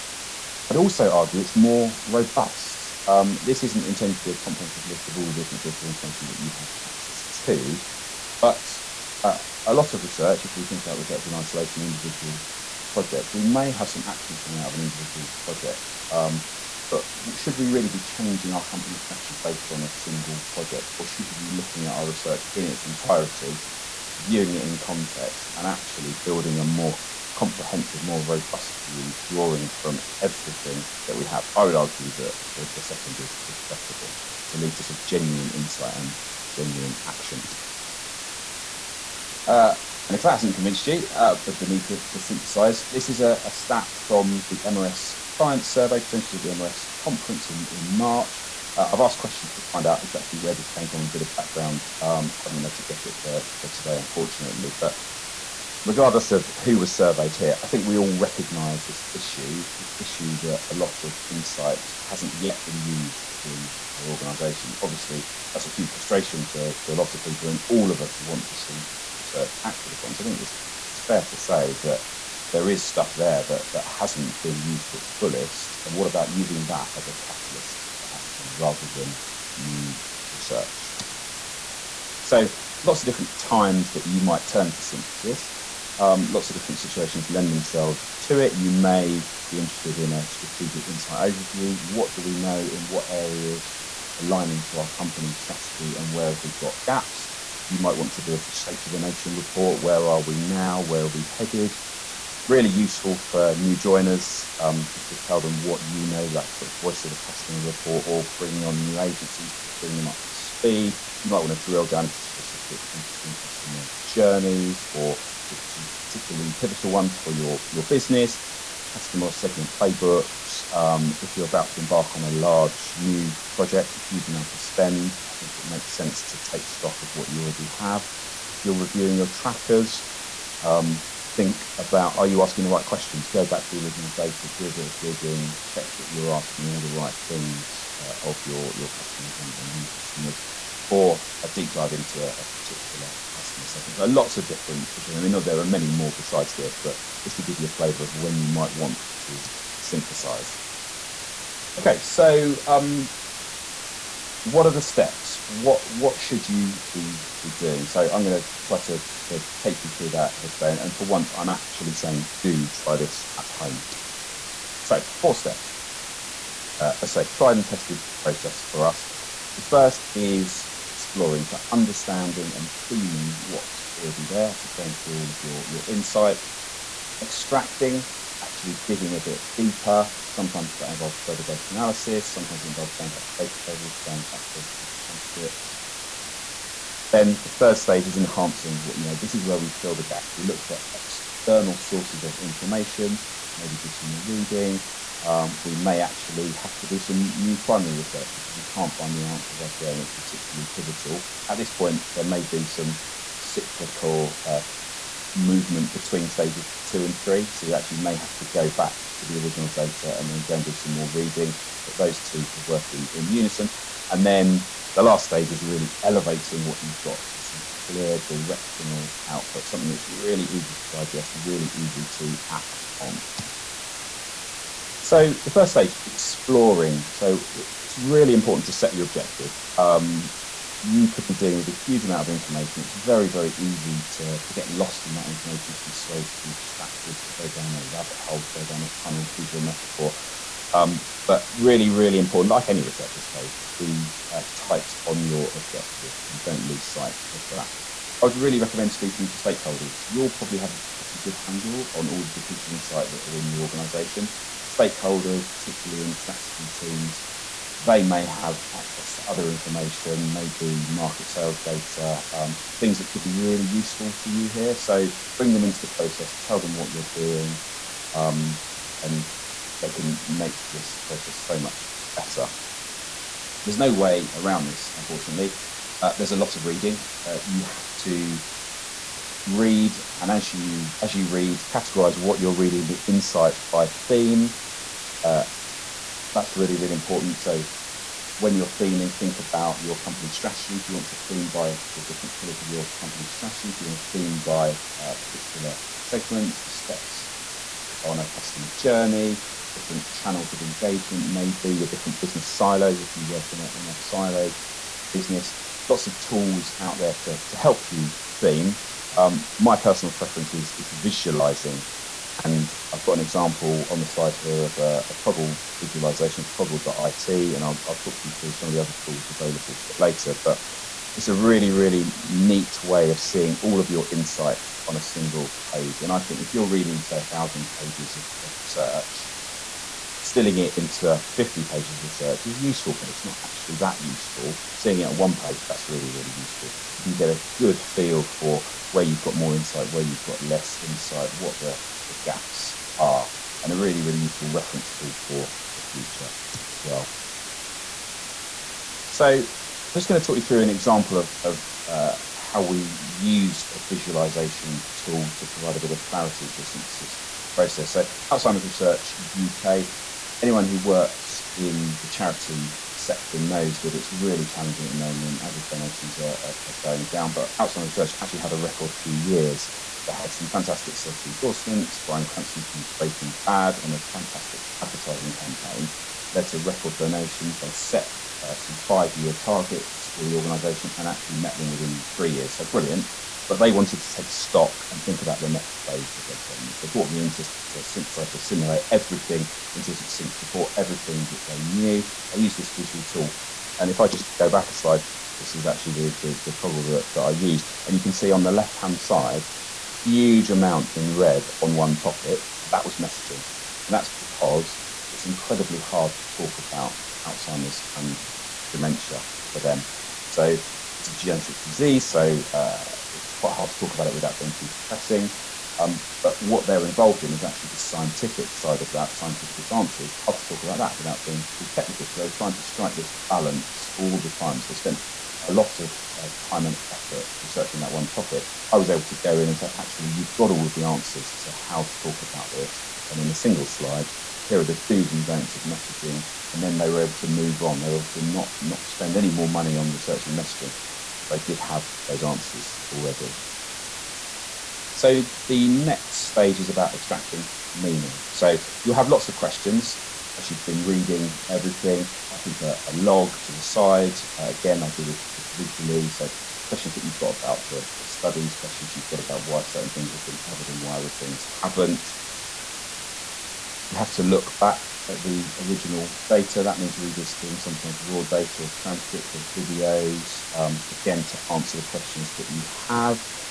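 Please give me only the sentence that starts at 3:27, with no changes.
So you actually may have to go back to the original data and then go and do some more reading.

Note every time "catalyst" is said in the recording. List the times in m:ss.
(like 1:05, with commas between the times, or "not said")
1:17.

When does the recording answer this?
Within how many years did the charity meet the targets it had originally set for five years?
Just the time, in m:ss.
6:22.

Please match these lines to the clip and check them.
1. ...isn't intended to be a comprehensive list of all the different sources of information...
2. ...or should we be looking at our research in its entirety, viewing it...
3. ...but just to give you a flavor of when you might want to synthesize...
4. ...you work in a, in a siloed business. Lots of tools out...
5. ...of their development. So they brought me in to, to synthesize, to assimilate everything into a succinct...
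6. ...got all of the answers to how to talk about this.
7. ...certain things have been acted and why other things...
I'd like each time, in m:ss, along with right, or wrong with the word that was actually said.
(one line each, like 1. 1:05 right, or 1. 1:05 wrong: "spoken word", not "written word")
1. 0:03 right
2. 0:20 right
3. 2:26 right
4. 5:03 right
5. 6:26 right
6. 7:10 right
7. 7:39 wrong: "covered", not "acted".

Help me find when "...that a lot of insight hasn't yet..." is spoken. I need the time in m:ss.
1:00.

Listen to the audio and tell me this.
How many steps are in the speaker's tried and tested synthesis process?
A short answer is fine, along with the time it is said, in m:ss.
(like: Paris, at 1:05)
4, at 2:45.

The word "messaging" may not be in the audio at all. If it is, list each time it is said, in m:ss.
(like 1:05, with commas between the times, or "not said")
6:42, 7:15, 7:20.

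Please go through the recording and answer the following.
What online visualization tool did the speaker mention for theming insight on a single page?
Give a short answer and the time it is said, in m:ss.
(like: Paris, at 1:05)
Coggle, at 5:15.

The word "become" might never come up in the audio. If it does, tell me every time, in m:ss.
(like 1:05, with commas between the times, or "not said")
not said.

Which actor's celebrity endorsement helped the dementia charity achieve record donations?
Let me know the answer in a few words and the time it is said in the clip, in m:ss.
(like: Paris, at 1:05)
Bryan Cranston, at 6:11.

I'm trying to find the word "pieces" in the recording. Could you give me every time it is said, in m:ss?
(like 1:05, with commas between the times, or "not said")
4:12.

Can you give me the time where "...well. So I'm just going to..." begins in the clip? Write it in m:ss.
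5:46.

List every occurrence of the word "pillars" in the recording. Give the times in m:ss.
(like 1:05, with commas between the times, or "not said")
4:52.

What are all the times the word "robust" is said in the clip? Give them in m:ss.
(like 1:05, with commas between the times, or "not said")
0:02, 0:28.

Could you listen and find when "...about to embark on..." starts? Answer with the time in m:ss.
2:01.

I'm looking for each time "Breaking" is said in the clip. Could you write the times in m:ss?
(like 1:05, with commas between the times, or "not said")
6:12.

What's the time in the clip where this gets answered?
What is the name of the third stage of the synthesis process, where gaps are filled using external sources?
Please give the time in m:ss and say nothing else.
3:08.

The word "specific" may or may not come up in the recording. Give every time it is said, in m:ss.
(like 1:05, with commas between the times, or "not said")
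1:52.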